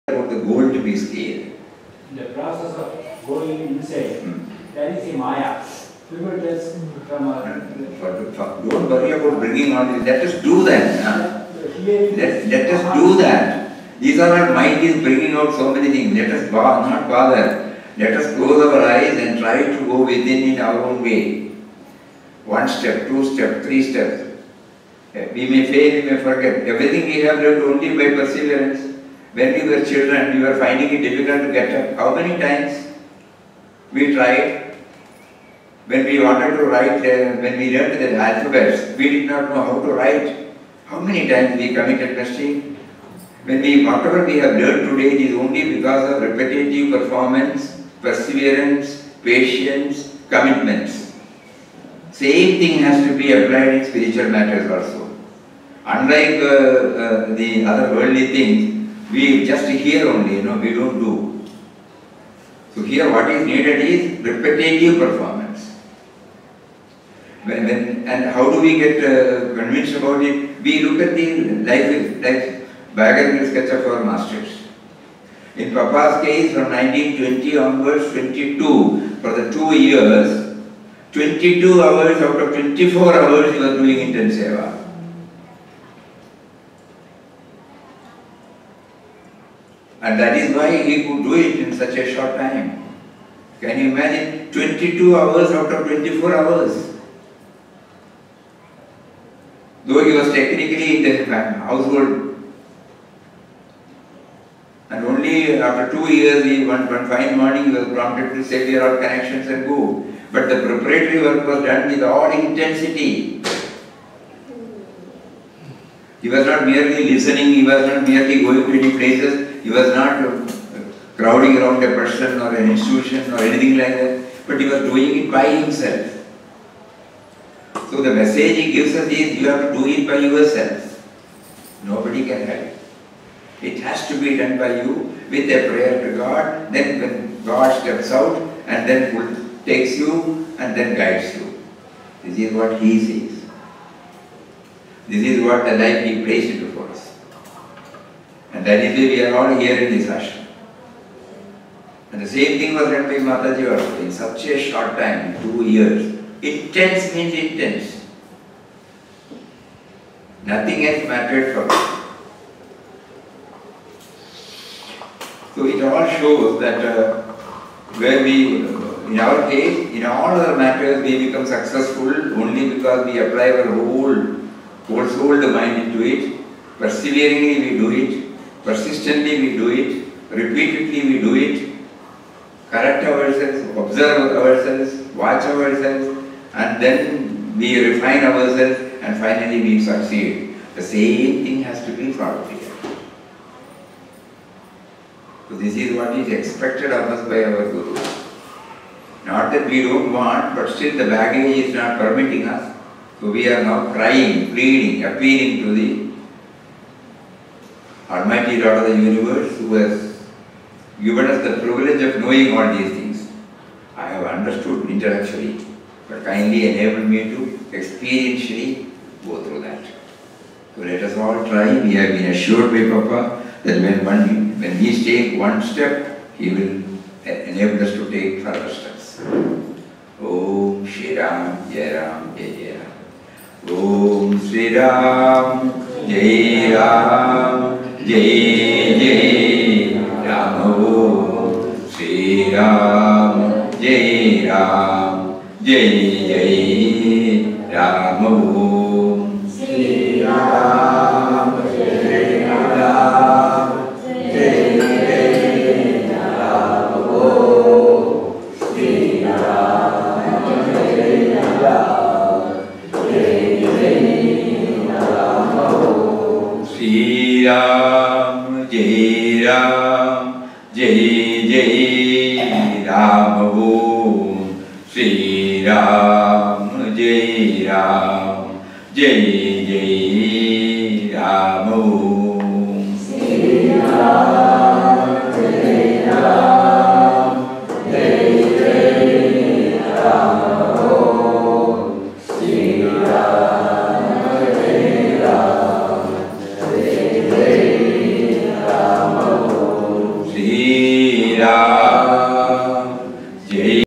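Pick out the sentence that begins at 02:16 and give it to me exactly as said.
Then when God steps out and then takes you and then guides you.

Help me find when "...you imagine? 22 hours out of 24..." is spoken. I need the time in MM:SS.
01:33.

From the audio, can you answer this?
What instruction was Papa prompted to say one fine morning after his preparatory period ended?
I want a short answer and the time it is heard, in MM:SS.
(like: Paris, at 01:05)
Clear all connections and go, at 01:48.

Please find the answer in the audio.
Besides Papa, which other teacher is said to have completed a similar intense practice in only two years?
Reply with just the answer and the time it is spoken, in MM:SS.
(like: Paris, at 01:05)
Mataji, at 02:33.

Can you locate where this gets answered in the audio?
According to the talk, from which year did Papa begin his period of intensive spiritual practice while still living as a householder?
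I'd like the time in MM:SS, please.
01:16.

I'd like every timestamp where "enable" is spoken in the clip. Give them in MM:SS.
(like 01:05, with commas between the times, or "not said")
03:36, 03:47.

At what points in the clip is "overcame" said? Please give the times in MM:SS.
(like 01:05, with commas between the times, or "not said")
not said.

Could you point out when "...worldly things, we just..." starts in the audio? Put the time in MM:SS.
00:57.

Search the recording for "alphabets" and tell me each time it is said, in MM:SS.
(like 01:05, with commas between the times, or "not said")
00:38.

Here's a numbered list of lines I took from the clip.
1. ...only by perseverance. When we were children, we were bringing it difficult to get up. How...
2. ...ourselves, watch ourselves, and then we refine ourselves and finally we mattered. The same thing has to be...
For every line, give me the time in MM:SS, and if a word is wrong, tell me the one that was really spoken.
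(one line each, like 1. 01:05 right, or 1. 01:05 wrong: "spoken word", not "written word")
1. 00:27 wrong: "finding", not "bringing"
2. 03:04 wrong: "succeed", not "mattered".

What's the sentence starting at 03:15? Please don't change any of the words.
So this is what is expected of us by our Guru.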